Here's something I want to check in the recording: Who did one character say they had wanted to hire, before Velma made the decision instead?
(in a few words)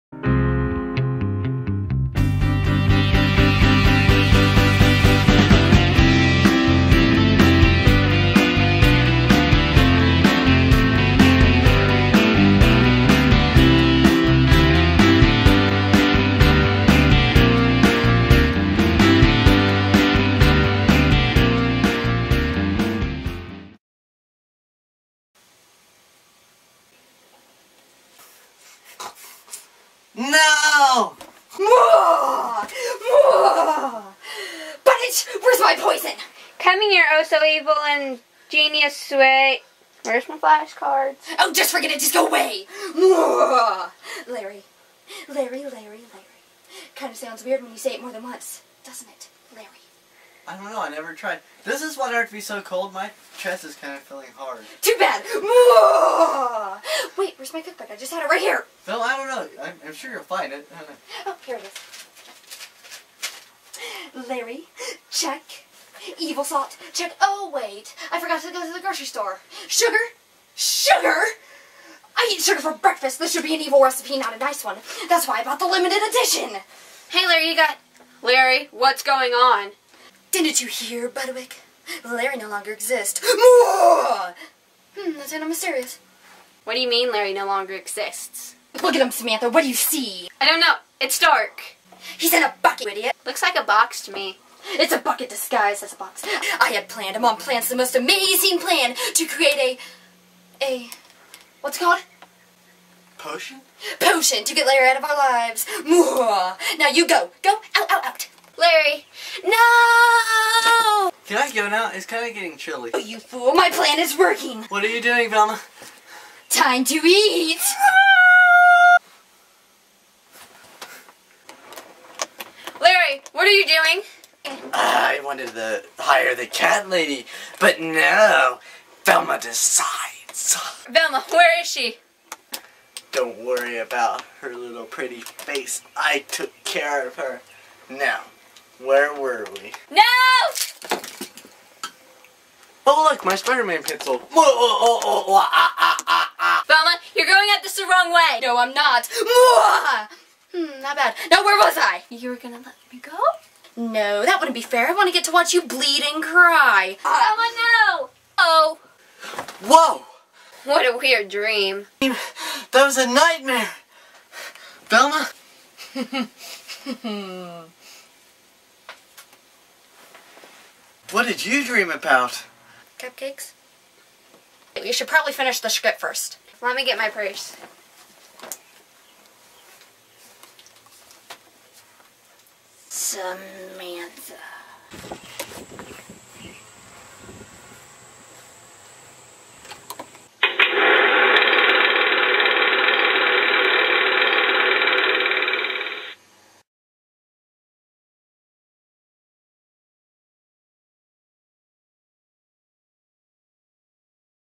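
The cat lady.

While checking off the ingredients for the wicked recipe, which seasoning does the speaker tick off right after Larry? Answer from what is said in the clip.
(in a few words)
Evil salt.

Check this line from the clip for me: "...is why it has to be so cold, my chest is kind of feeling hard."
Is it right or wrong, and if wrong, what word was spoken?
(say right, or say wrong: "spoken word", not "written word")
right.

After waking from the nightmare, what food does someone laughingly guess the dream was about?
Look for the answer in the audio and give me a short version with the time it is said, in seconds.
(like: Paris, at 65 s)
Cupcakes, at 173 s.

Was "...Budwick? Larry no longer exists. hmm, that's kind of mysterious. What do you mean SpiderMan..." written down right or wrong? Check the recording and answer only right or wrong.
wrong.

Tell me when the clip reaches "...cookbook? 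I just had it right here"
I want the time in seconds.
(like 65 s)
57 s.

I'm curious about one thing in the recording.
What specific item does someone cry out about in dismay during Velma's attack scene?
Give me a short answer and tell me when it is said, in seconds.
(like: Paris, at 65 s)
Spider-Man pencil, at 143 s.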